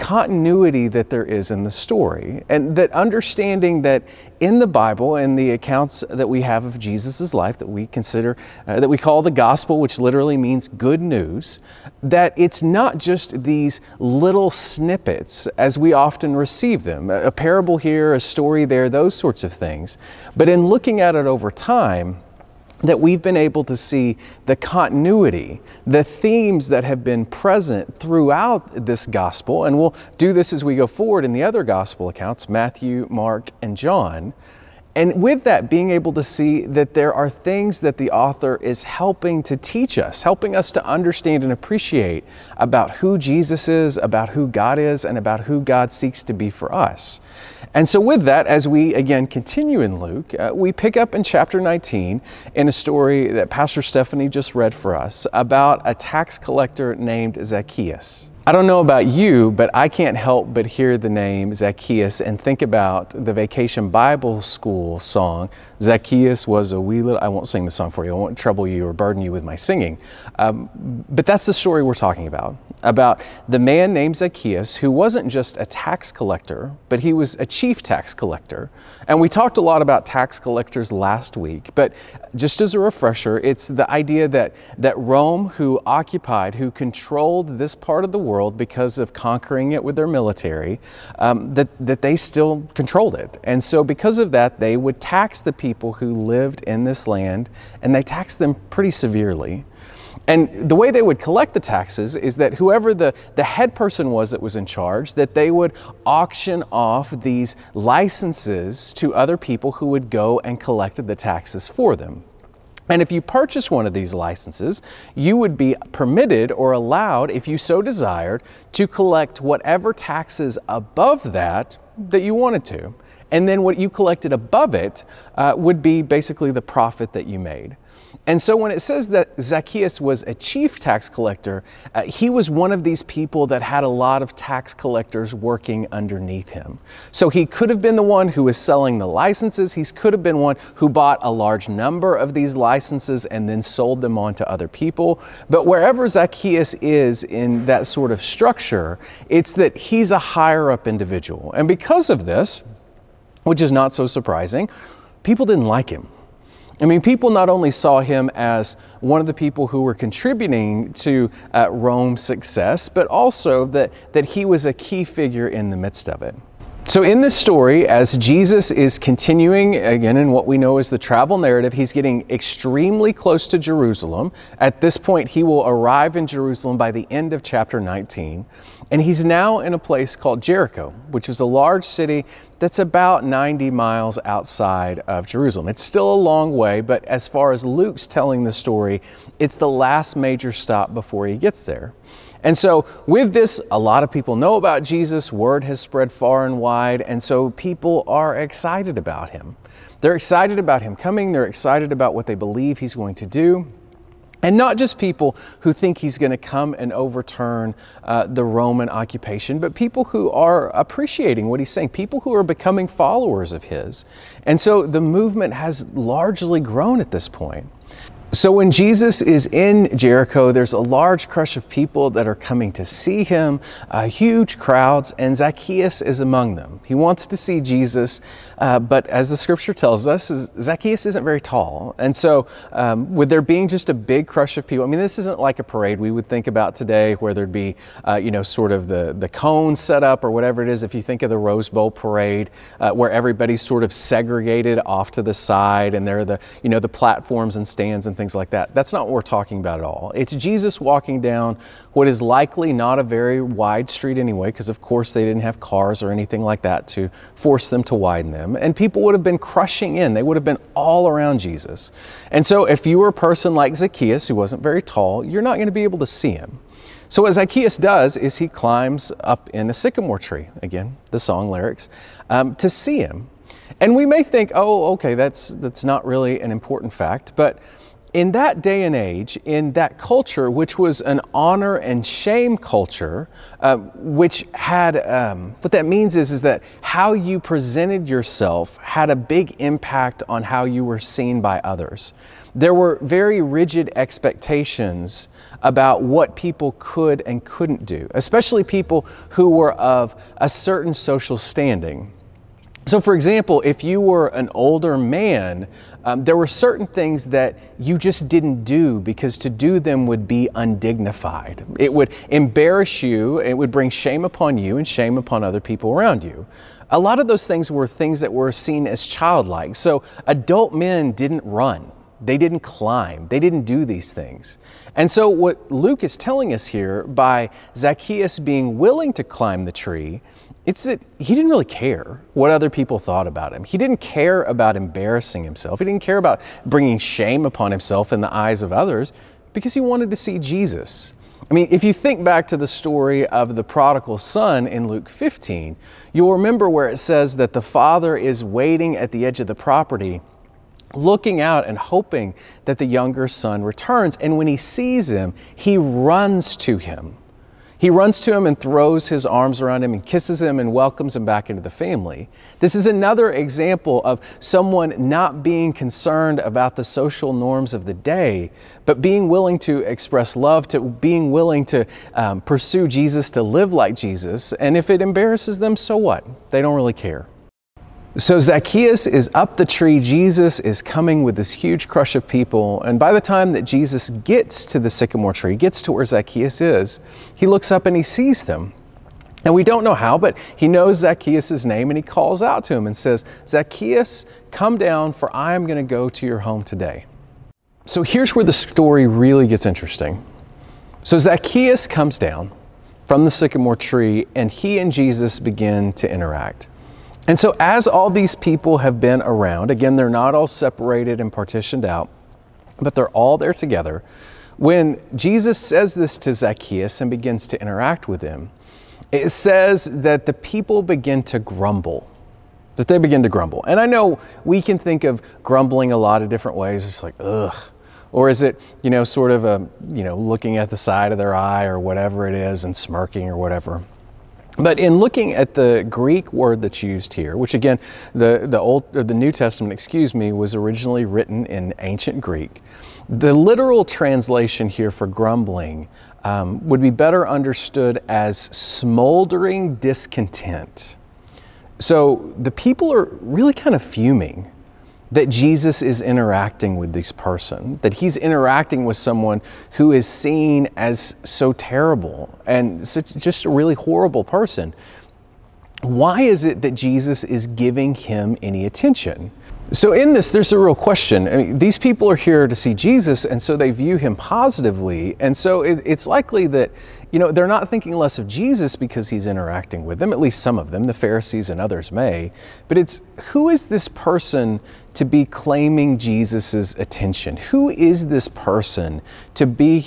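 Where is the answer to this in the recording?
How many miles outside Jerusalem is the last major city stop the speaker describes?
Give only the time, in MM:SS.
03:03.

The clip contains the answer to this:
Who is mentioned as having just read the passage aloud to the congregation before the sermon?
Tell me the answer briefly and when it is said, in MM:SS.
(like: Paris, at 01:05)
Pastor Stephanie, at 00:53.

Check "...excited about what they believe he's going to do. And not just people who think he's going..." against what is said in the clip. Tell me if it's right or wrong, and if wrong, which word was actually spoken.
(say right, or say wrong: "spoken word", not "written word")
right.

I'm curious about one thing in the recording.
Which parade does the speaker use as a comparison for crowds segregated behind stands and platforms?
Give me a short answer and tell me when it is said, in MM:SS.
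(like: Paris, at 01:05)
Rose Bowl parade, at 04:01.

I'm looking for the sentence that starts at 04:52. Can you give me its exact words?
There were very rigid expectations about what people could and couldn't do, especially people who were of a certain social standing.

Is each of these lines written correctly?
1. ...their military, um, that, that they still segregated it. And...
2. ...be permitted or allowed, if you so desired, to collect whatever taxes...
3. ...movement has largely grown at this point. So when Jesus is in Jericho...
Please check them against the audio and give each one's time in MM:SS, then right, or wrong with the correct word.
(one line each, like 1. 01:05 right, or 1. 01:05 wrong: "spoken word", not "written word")
1. 01:29 wrong: "controlled", not "segregated"
2. 01:55 right
3. 03:34 right.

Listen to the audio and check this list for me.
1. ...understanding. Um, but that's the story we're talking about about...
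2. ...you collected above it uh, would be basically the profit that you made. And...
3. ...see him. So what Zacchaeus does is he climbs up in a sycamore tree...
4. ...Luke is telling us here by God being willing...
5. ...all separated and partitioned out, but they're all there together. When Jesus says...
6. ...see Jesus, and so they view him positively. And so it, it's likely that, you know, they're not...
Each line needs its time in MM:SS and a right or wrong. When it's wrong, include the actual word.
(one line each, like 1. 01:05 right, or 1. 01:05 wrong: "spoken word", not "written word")
1. 01:09 wrong: "singing", not "understanding"
2. 02:03 right
3. 04:26 right
4. 05:25 wrong: "Zacchaeus", not "God"
5. 06:50 right
6. 07:52 right.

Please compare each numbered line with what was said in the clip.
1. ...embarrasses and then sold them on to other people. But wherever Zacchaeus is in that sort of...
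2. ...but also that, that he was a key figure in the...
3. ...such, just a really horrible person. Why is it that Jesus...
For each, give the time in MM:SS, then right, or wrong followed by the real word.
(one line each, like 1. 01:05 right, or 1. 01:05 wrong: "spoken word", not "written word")
1. 02:22 wrong: "licenses", not "embarrasses"
2. 02:42 right
3. 07:42 right.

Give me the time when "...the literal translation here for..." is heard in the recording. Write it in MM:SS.
07:23.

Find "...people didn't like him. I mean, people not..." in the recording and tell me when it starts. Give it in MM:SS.
02:35.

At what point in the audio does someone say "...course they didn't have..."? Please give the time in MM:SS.
04:14.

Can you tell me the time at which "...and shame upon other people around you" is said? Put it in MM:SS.
05:14.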